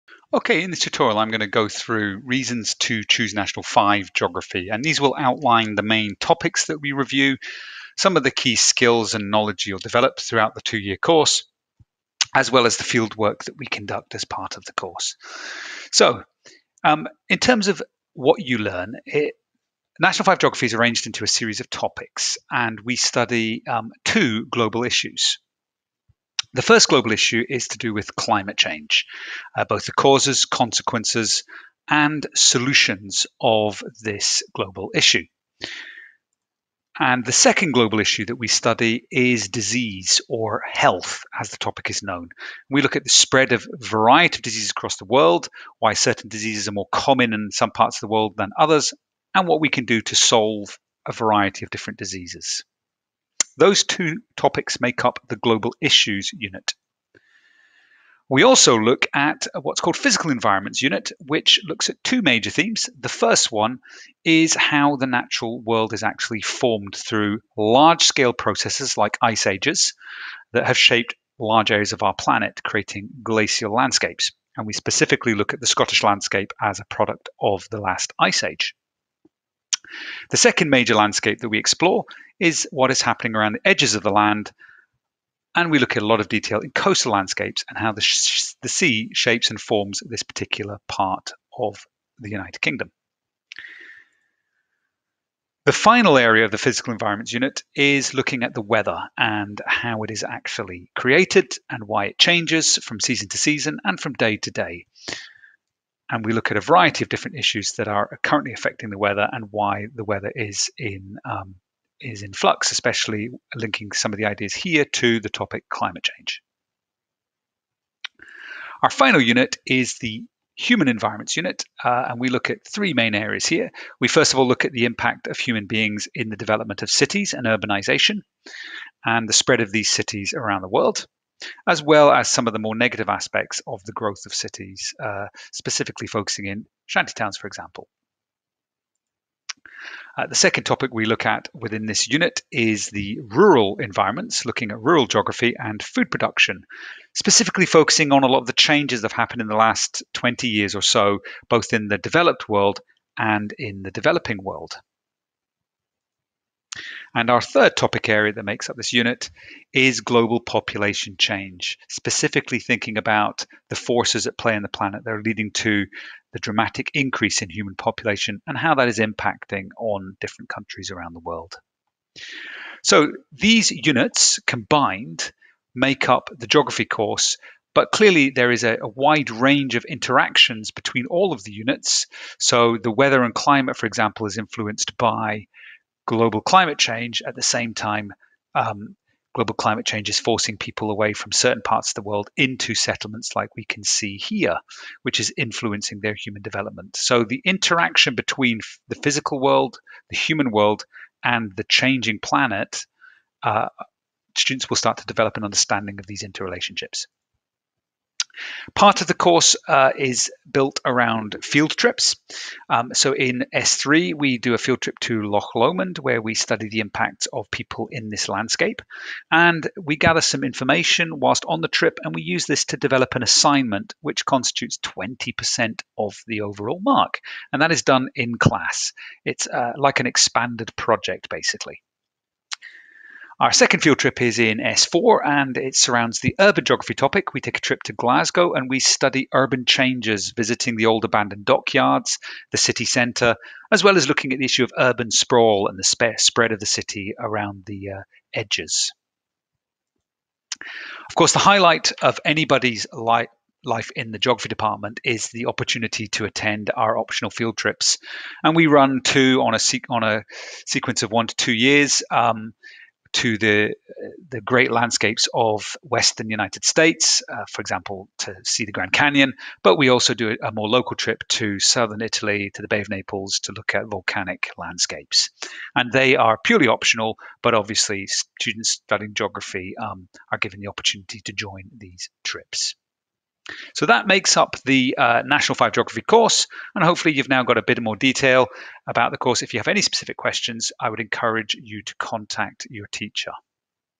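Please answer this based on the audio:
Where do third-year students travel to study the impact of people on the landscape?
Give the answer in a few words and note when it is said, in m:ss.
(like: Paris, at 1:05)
Loch Lomond, at 3:35.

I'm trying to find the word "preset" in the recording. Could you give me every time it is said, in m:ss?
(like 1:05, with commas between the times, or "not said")
not said.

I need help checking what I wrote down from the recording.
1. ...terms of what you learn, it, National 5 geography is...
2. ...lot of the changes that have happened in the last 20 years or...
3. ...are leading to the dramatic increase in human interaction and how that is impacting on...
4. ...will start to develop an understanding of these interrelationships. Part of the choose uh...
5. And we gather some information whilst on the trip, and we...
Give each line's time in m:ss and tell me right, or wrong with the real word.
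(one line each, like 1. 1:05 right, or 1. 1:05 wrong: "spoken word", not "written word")
1. 0:17 right
2. 2:28 right
3. 2:45 wrong: "population", not "interaction"
4. 3:24 wrong: "course", not "choose"
5. 3:39 right.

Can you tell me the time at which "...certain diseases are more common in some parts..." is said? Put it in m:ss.
0:45.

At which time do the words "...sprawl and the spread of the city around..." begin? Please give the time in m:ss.
4:05.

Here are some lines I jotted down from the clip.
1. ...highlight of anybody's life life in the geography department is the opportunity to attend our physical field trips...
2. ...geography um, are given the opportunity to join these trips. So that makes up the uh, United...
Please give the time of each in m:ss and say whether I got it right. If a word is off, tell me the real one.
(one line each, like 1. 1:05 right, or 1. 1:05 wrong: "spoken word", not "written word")
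1. 4:11 wrong: "optional", not "physical"
2. 4:39 wrong: "National", not "United".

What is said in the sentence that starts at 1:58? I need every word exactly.
Our final unit is the human environments unit, uh, and we look at three main areas here.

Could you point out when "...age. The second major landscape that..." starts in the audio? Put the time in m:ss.
1:18.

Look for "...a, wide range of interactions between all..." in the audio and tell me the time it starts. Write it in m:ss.
2:58.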